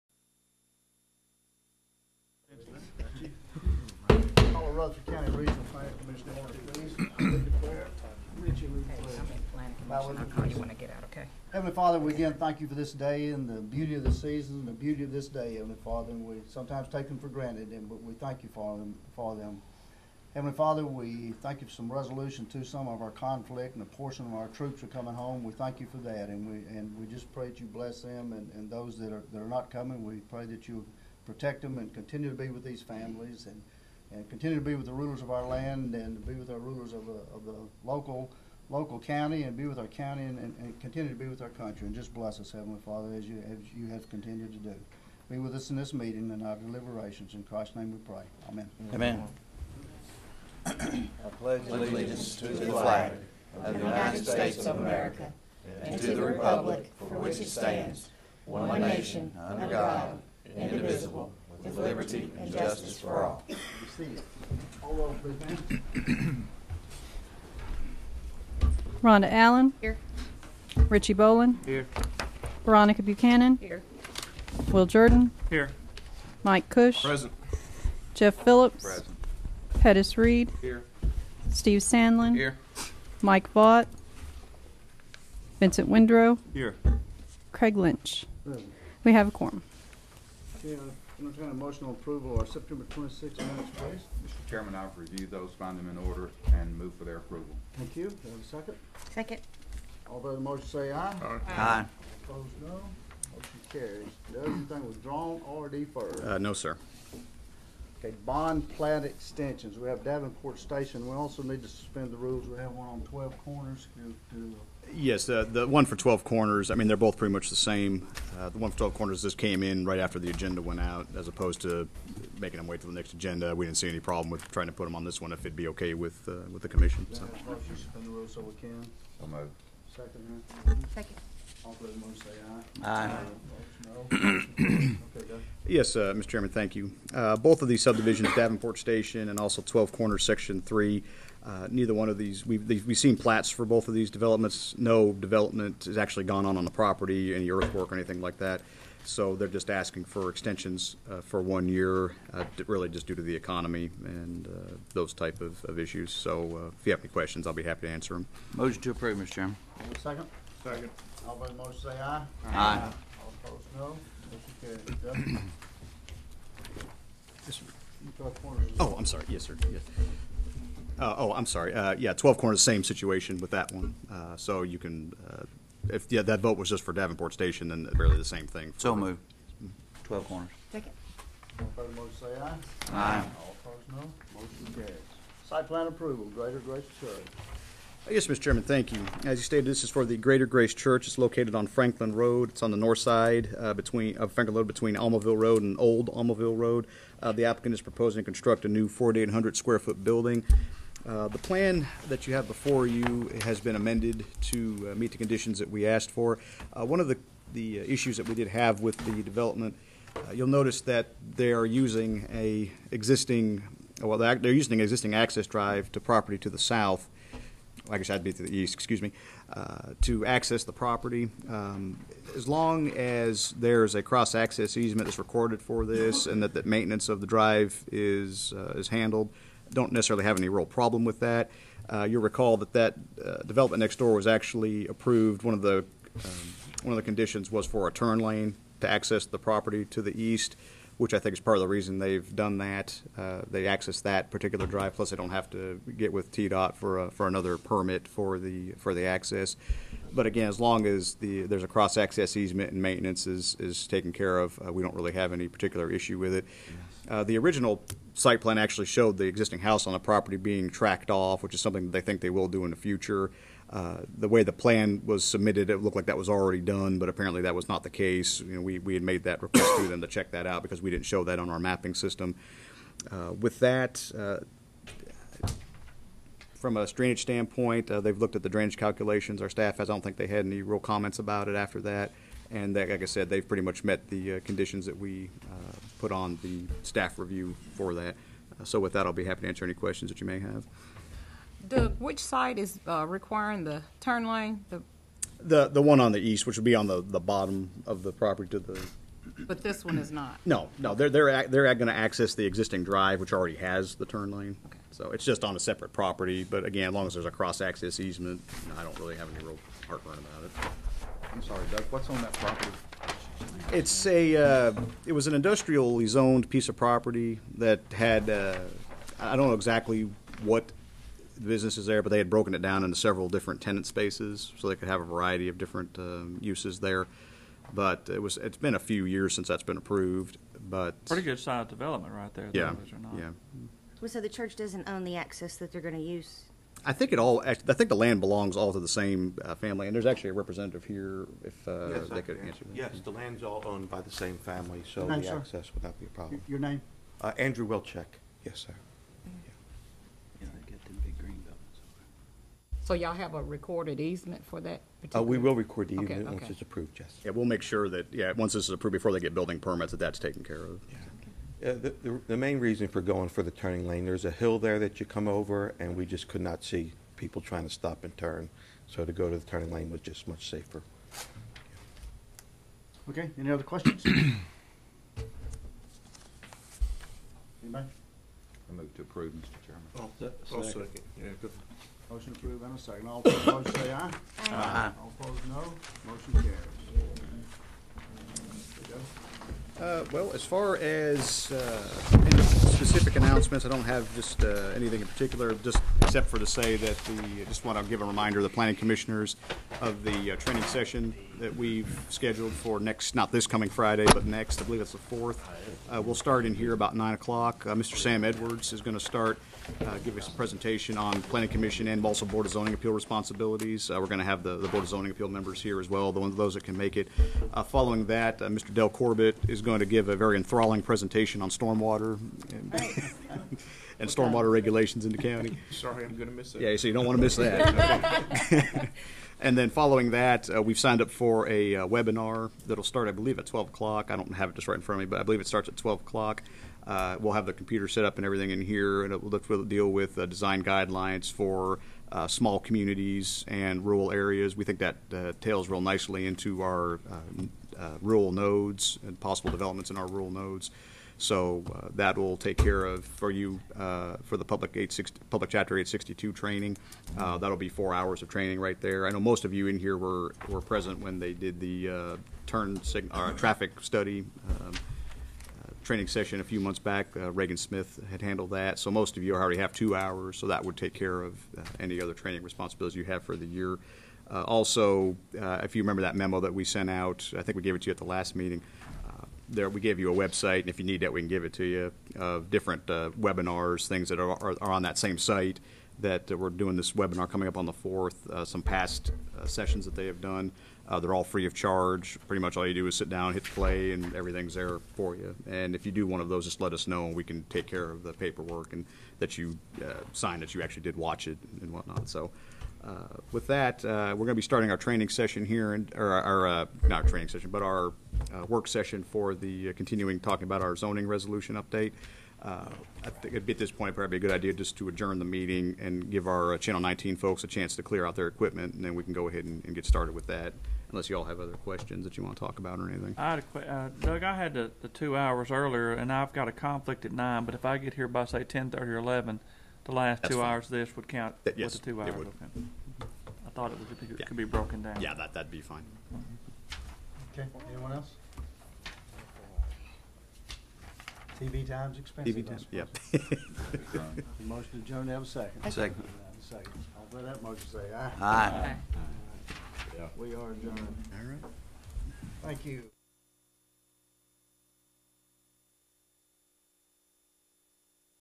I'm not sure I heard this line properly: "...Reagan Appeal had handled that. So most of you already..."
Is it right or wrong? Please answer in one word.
wrong.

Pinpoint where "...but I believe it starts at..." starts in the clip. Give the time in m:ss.
7:15.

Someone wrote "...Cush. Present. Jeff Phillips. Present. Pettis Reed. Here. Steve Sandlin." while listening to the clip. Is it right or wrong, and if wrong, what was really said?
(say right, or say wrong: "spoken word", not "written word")
right.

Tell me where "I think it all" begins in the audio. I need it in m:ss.
5:36.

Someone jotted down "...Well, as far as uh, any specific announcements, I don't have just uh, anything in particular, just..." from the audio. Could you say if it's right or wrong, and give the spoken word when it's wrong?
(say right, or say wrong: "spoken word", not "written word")
right.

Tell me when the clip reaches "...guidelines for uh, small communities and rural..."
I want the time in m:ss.
7:20.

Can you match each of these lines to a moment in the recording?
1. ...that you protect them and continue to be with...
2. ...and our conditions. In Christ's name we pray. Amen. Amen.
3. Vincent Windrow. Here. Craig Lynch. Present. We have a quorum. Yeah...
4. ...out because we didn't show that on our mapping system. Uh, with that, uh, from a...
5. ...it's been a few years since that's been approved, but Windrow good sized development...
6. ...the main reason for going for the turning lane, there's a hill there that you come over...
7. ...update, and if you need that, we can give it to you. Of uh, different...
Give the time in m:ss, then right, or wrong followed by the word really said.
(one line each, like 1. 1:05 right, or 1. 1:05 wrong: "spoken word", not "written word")
1. 0:30 right
2. 0:46 wrong: "deliberations", not "conditions"
3. 1:25 right
4. 4:30 right
5. 5:28 wrong: "Pretty", not "Windrow"
6. 6:02 right
7. 8:00 wrong: "website", not "update".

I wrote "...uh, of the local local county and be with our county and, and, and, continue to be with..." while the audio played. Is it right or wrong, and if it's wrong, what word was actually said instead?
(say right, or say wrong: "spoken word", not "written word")
right.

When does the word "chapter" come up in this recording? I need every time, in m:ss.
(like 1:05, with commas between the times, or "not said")
7:35.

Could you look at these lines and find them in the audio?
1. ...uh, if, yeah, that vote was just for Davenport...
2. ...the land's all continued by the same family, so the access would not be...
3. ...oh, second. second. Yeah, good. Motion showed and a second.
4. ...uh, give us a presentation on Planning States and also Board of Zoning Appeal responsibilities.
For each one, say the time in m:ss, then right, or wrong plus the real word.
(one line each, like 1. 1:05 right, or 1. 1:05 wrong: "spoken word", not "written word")
1. 2:55 right
2. 5:43 wrong: "owned", not "continued"
3. 6:20 wrong: "approved", not "showed"
4. 6:49 wrong: "Commission", not "States".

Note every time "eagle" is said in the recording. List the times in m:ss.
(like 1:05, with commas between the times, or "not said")
not said.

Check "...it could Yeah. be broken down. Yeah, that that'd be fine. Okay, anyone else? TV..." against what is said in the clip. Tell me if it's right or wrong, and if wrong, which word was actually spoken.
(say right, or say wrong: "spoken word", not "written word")
right.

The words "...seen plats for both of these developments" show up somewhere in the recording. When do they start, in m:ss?
2:22.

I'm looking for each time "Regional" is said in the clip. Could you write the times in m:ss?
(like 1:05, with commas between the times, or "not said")
0:05.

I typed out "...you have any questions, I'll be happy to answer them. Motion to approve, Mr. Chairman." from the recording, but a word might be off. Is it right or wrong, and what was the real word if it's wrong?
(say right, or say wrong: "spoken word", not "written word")
right.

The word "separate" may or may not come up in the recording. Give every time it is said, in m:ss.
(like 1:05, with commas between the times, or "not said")
5:05.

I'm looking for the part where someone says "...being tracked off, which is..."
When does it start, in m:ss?
4:20.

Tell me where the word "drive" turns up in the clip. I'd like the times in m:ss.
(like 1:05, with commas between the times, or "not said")
3:35, 3:47, 4:04, 5:02.